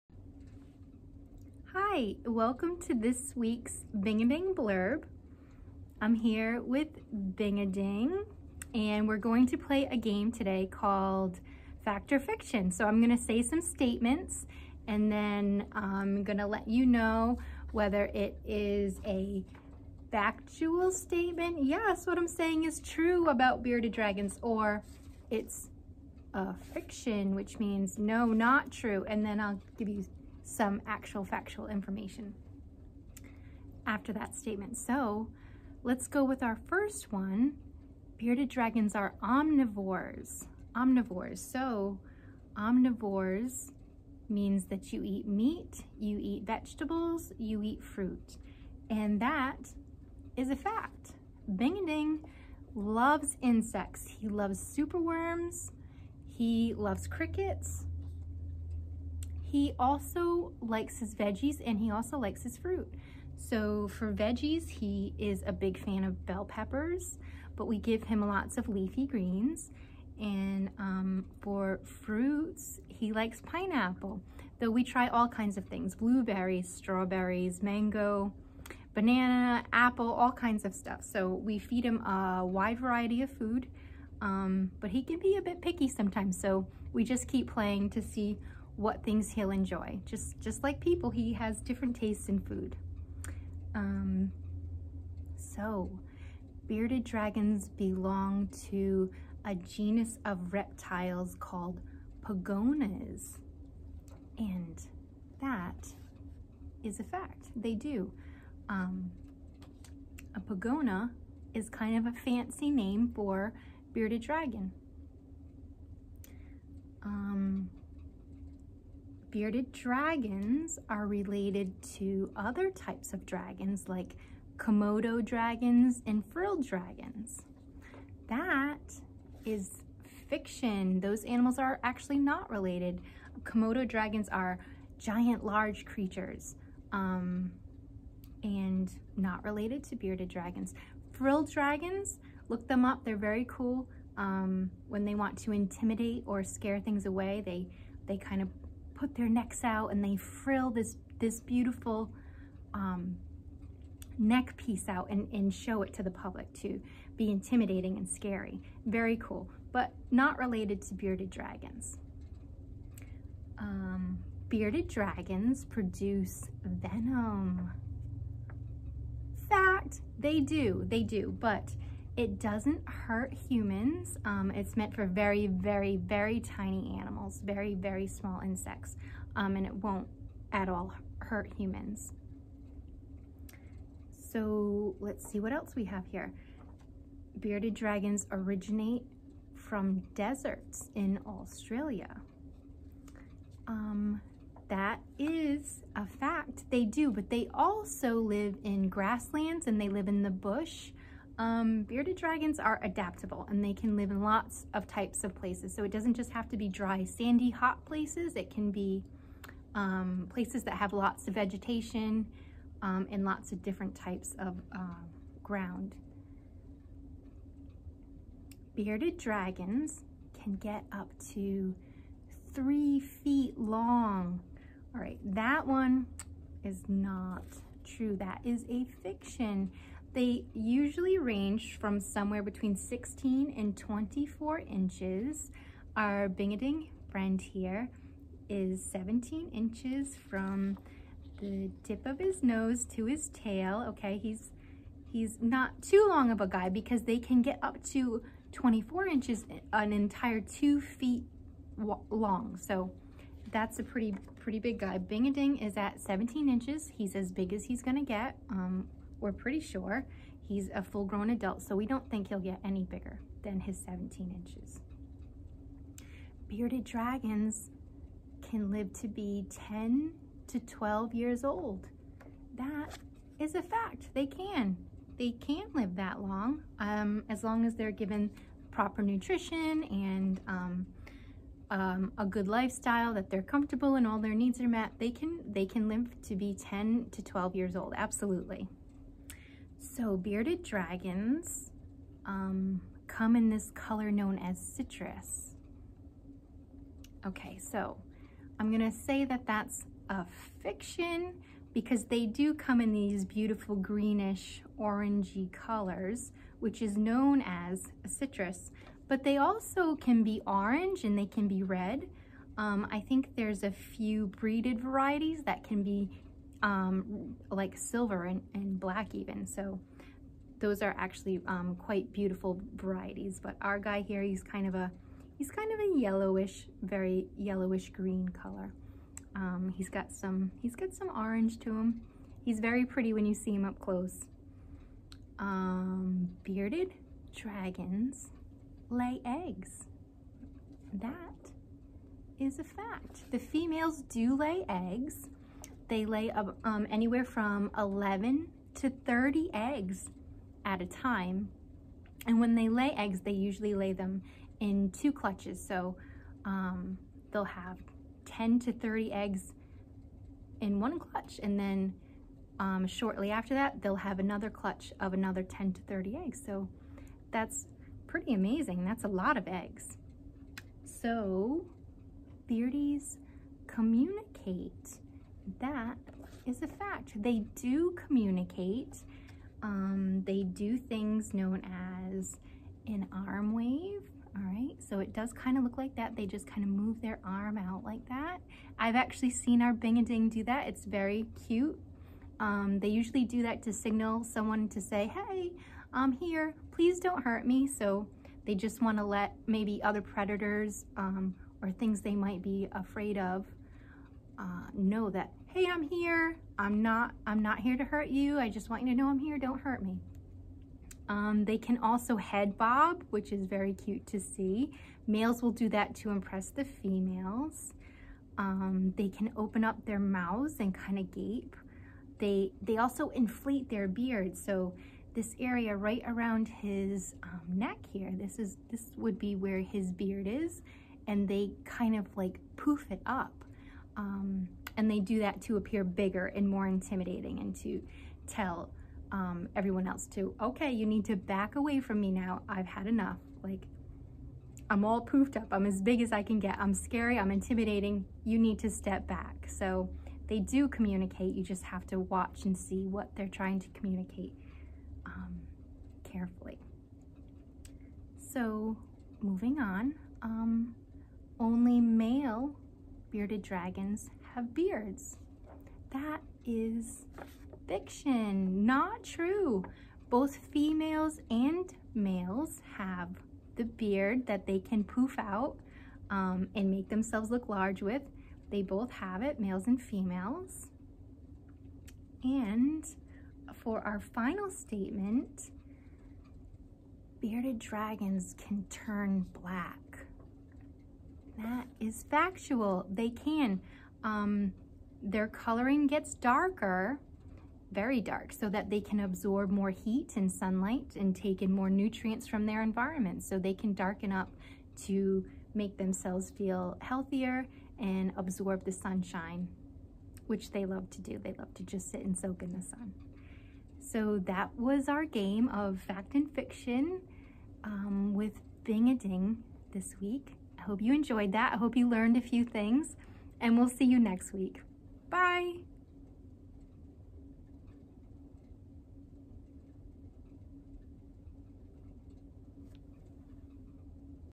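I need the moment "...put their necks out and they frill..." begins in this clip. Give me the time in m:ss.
2:29.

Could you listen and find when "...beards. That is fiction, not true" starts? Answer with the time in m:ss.
7:44.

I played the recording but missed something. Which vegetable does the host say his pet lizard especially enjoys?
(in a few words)
bell peppers.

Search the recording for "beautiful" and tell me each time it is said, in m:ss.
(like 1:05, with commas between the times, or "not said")
2:31, 5:03, 5:22.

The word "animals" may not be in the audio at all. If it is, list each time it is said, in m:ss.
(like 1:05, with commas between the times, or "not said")
2:11, 2:56.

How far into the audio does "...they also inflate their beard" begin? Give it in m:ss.
7:02.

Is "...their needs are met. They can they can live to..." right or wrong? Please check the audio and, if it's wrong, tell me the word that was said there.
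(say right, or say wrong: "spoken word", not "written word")
right.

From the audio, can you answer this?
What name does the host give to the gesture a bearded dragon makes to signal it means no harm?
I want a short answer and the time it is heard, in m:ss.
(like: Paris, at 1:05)
arm wave, at 6:23.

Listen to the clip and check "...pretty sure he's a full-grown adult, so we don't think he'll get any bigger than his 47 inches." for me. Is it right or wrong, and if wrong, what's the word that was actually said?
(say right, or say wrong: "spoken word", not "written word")
wrong: "17", not "47".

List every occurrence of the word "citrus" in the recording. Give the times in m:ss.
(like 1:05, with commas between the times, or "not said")
4:54, 5:08.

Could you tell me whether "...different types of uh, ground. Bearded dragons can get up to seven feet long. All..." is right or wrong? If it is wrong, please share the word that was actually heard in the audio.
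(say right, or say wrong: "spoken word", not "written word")
wrong: "three", not "seven".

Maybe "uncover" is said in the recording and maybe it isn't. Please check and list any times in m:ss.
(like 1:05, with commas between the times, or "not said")
not said.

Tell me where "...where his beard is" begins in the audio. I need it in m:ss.
7:09.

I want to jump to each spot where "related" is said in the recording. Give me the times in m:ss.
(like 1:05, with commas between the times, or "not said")
2:01, 2:12, 2:19, 2:40.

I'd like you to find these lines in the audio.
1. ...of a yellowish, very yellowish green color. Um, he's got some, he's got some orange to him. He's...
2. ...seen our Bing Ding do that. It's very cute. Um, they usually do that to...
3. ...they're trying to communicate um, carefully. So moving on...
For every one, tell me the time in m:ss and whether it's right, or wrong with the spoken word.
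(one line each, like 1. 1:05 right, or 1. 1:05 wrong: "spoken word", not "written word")
1. 5:25 right
2. 6:29 right
3. 7:33 right.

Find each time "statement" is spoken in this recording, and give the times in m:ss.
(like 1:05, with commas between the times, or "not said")
0:13, 0:20, 0:34, 8:04.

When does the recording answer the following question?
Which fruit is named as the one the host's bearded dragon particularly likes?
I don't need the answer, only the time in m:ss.
1:13.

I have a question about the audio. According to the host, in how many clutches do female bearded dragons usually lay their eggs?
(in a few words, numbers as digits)
2.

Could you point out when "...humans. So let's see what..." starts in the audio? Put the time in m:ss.
3:01.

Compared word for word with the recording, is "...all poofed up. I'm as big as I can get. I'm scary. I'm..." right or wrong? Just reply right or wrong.
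right.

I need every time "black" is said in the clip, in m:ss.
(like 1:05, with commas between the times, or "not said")
5:18, 8:09.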